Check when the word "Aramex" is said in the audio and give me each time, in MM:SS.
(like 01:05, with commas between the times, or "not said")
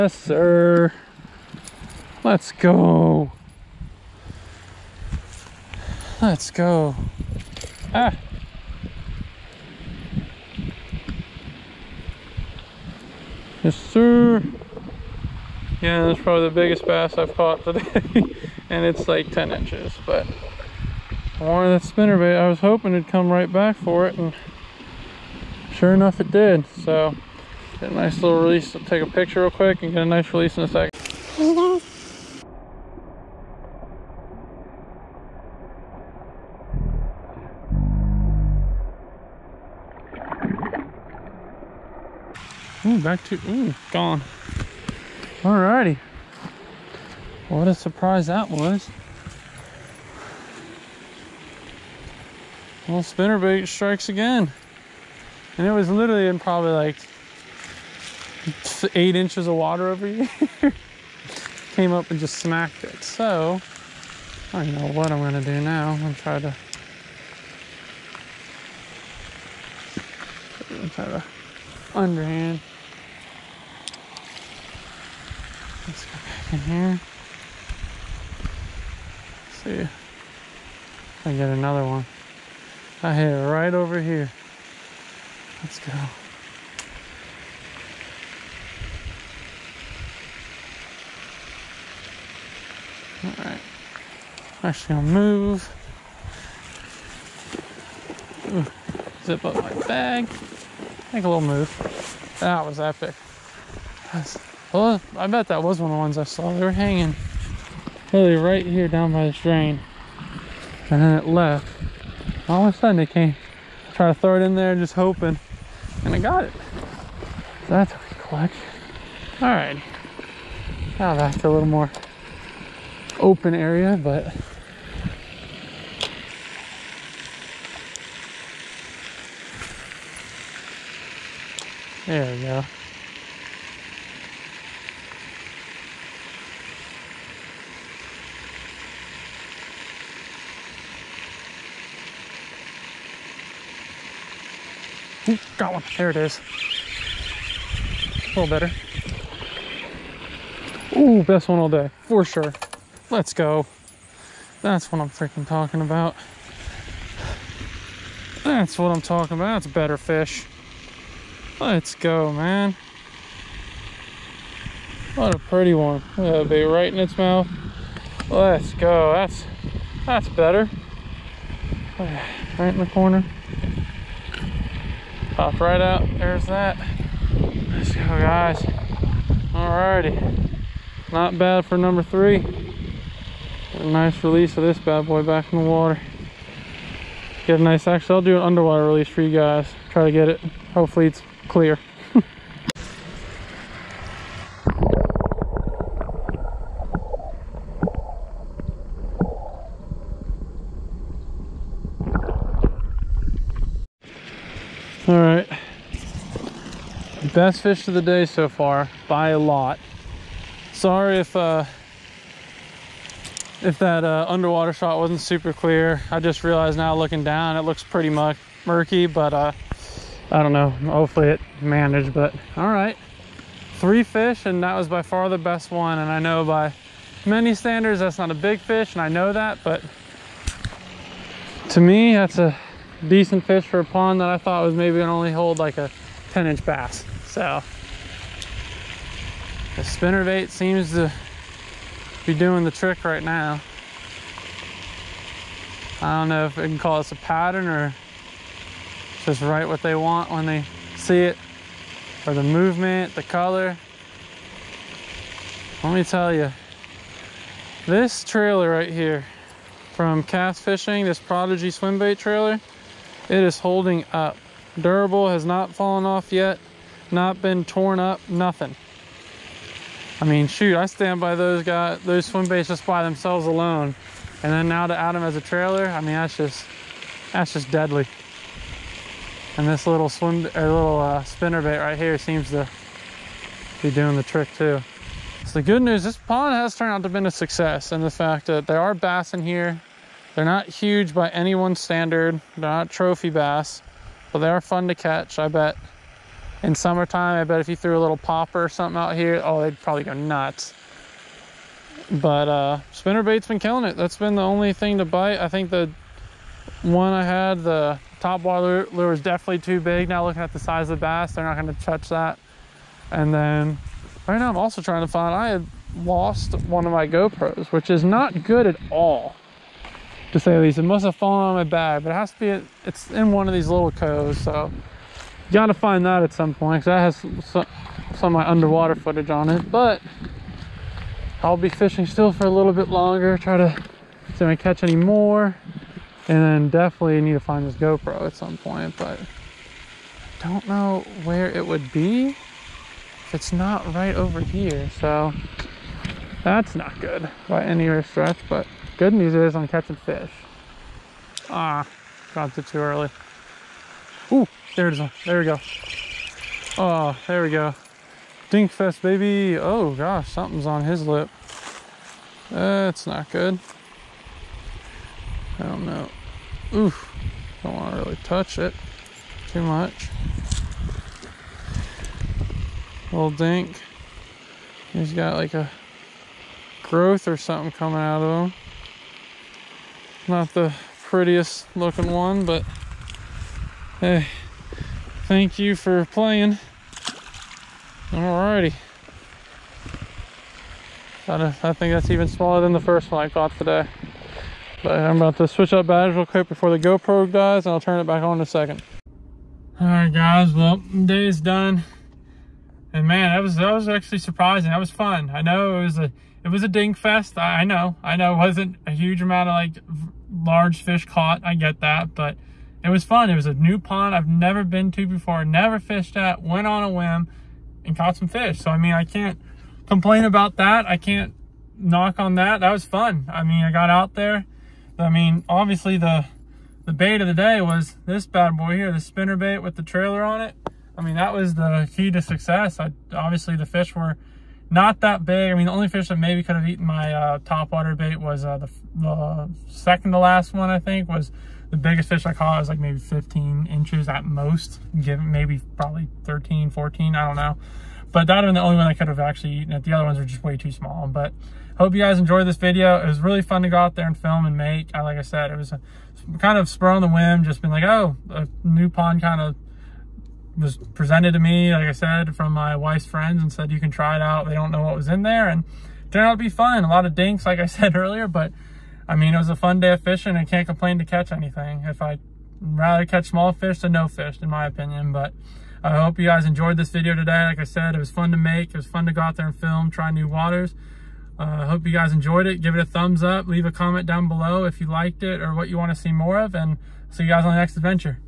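not said.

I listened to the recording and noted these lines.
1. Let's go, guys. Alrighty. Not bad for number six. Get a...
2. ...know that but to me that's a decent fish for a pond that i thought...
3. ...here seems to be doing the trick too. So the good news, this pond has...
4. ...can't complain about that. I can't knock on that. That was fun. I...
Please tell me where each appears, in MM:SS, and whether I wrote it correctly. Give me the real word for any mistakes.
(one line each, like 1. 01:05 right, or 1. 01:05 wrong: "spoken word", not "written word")
1. 02:57 wrong: "three", not "six"
2. 03:49 right
3. 04:41 right
4. 06:59 right.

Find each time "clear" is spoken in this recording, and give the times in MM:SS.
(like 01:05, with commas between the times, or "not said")
03:11, 03:35.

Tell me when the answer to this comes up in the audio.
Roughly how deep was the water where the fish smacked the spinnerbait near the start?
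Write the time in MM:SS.
00:58.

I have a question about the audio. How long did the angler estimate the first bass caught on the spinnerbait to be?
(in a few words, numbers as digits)
10 inches.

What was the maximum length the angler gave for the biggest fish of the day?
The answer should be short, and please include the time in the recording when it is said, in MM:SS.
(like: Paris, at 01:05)
15 inches, at 07:22.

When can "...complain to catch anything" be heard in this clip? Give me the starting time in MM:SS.
07:50.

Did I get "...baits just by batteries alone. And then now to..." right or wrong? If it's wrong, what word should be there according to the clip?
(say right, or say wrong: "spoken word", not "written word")
wrong: "themselves", not "batteries".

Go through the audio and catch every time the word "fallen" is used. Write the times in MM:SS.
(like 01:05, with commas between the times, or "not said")
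04:25, 05:21.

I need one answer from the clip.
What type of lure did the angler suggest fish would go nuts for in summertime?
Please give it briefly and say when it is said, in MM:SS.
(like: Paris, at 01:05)
popper, at 04:58.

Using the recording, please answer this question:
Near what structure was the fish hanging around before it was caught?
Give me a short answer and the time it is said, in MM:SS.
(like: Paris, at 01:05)
drain, at 01:49.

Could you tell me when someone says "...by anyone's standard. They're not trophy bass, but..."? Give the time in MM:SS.
04:51.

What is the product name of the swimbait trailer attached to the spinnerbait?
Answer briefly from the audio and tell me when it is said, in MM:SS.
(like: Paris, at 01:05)
Prodigy, at 04:21.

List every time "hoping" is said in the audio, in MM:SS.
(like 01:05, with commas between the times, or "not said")
00:22, 01:54.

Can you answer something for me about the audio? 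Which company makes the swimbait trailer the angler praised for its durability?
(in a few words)
Cast Fishing.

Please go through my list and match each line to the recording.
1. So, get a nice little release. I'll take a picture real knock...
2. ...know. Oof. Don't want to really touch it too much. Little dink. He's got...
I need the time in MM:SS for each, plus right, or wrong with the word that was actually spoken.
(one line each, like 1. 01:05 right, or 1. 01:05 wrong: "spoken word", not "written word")
1. 00:26 wrong: "quick", not "knock"
2. 06:05 right.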